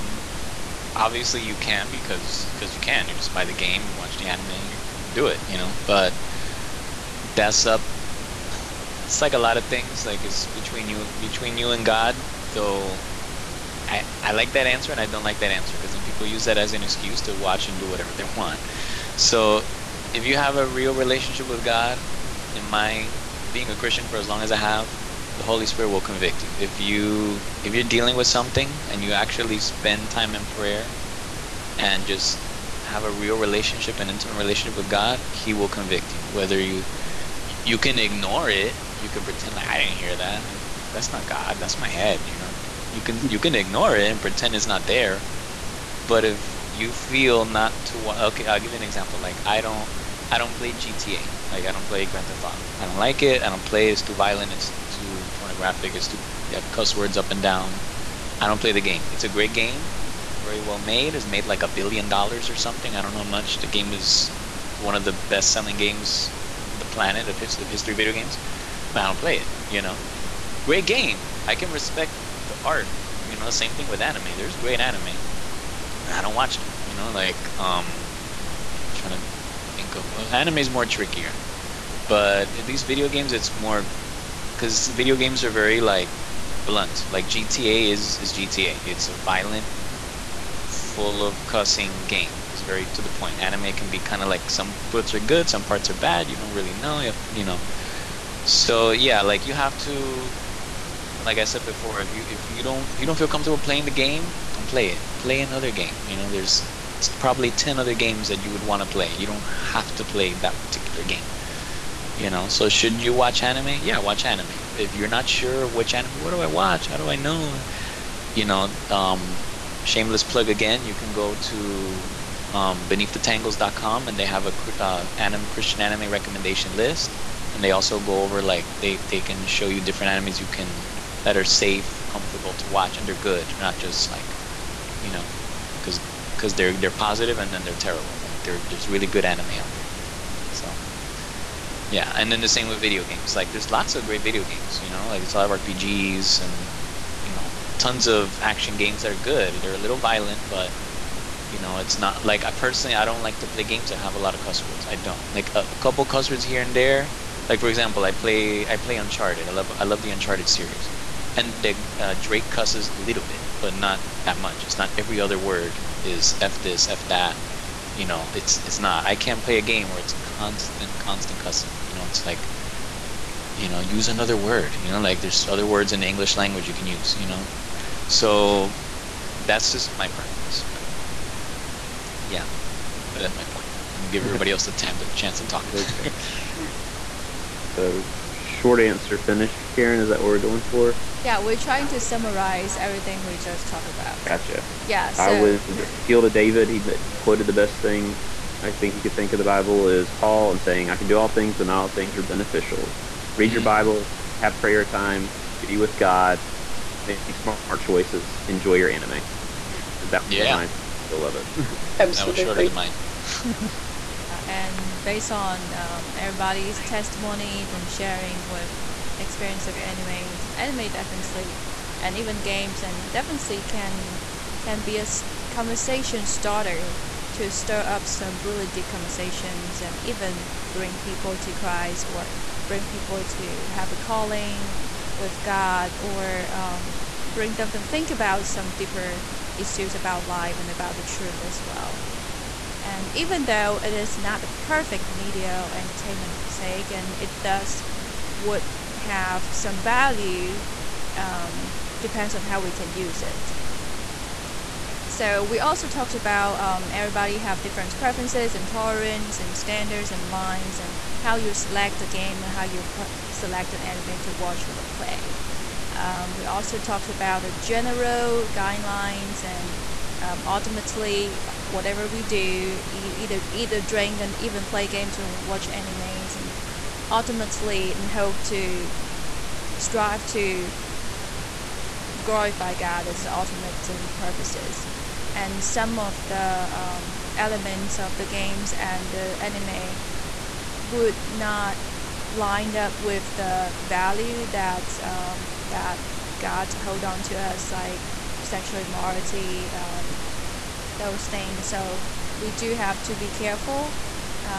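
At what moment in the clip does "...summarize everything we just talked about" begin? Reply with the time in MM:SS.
03:11.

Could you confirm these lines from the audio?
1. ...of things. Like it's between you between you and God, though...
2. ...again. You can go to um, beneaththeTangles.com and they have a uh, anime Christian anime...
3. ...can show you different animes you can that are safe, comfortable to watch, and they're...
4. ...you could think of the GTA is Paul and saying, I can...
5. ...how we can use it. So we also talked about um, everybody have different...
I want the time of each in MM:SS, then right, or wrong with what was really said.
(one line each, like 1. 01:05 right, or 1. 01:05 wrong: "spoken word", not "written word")
1. 00:09 right
2. 02:00 right
3. 02:09 right
4. 03:18 wrong: "Bible", not "GTA"
5. 04:12 right.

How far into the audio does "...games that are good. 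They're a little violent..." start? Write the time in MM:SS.
02:28.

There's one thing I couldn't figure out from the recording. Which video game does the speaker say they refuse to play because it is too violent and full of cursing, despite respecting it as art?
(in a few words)
Grand Theft Auto.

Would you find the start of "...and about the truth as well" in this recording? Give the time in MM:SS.
04:00.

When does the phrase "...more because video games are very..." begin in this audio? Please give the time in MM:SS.
01:23.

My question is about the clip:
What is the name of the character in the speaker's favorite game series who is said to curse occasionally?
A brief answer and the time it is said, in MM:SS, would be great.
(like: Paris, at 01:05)
Drake, at 02:42.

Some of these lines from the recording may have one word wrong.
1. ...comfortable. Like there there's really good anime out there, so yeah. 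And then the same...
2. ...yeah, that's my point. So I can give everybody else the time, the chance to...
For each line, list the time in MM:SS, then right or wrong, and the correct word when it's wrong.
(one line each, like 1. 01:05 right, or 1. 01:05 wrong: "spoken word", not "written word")
1. 02:17 wrong: "terrible", not "comfortable"
2. 03:02 right.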